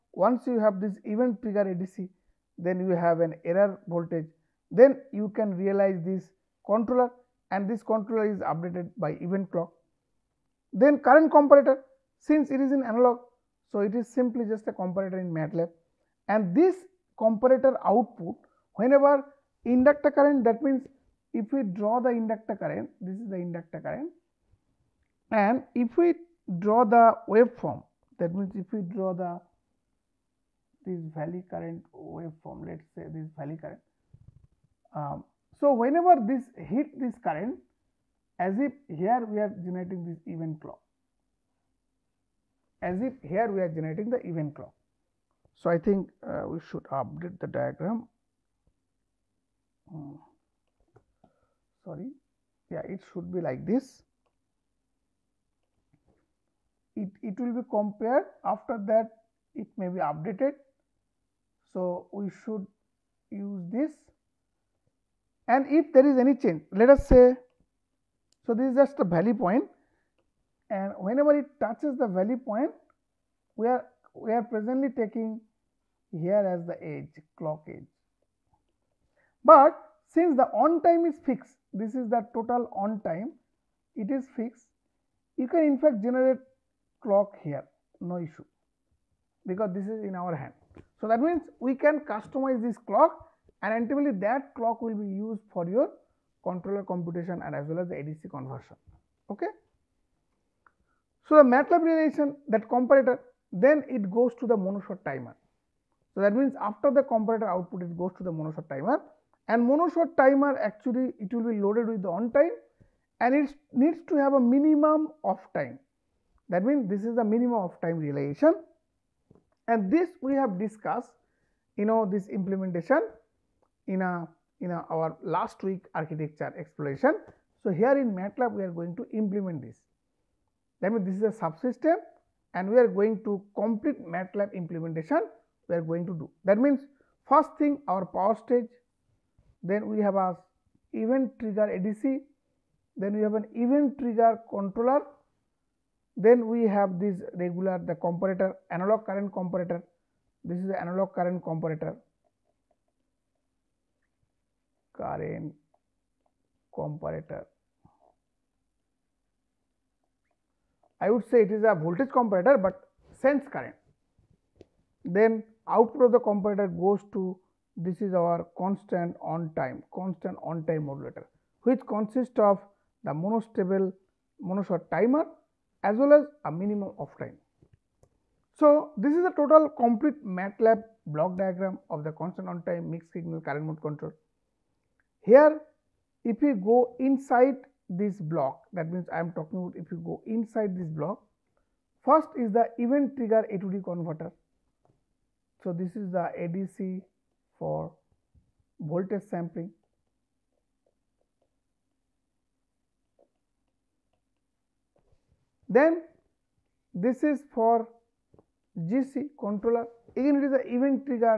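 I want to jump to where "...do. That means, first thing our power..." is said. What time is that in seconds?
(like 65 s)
136 s.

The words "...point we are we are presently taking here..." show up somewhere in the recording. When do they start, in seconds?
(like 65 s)
72 s.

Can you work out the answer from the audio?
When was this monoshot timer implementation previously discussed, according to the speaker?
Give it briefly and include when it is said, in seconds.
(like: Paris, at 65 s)
Last week, at 125 s.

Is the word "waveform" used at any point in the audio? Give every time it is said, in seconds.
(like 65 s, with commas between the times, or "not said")
27 s, 31 s.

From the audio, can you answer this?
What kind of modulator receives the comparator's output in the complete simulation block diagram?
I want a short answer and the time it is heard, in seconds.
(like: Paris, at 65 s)
Constant on time modulator, at 169 s.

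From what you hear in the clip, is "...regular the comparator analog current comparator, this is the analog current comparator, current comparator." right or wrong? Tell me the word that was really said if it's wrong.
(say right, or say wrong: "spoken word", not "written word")
right.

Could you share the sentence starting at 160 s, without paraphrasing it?
I would say it is a voltage comparator, but sense current.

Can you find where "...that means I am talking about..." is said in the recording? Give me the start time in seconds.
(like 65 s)
188 s.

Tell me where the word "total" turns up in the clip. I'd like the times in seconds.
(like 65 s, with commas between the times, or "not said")
82 s, 179 s.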